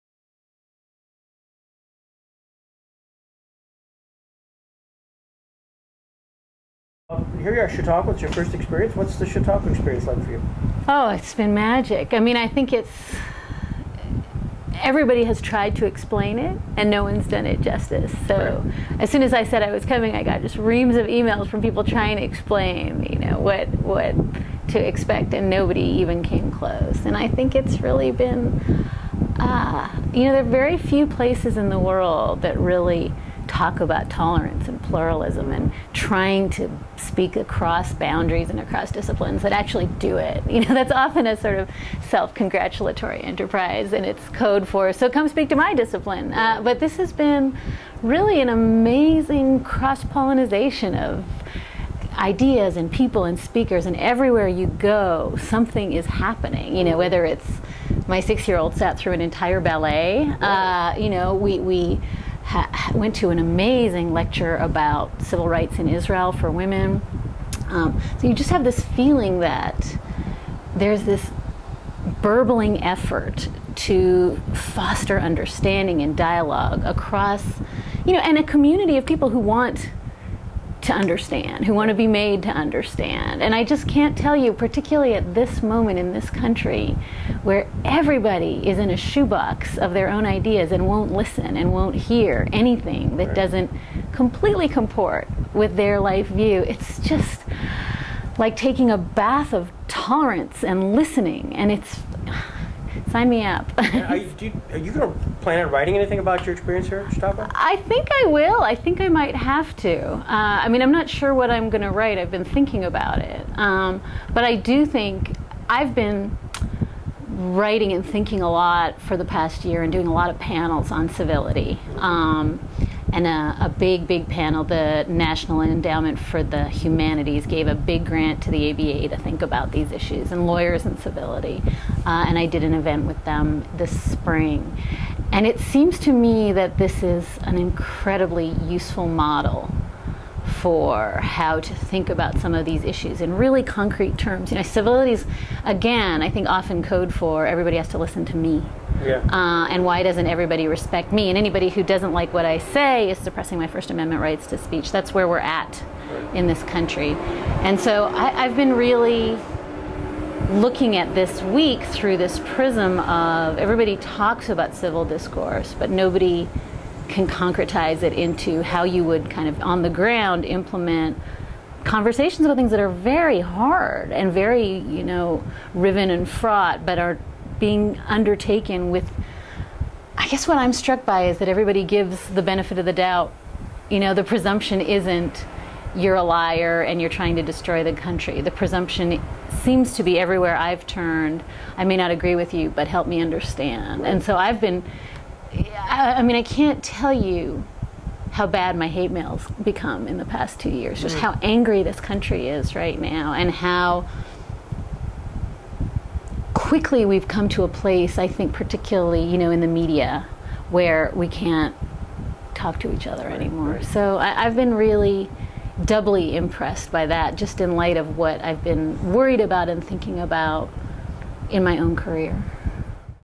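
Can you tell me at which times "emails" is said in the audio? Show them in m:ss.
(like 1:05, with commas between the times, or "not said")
0:21.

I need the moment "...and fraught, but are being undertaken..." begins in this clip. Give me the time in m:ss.
2:56.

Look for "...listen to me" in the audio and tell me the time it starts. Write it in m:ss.
2:27.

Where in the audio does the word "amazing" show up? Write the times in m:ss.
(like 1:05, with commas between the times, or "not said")
0:48, 1:03.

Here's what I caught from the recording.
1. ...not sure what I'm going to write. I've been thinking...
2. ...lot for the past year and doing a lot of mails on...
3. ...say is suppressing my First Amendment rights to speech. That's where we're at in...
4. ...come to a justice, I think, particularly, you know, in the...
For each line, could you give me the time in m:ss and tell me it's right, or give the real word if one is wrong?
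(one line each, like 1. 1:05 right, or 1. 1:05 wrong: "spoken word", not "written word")
1. 1:50 right
2. 1:58 wrong: "panels", not "mails"
3. 2:32 right
4. 3:27 wrong: "place", not "justice".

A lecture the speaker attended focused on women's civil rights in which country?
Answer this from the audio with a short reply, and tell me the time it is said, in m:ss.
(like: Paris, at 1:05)
Israel, at 1:05.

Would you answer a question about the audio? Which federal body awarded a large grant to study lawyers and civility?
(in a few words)
National Endowment for the Humanities.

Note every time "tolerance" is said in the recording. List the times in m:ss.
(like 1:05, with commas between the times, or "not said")
0:34, 1:39.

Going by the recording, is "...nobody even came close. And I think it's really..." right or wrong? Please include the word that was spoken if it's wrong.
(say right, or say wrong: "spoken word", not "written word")
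right.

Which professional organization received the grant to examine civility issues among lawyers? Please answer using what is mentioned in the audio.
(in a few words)
ABA.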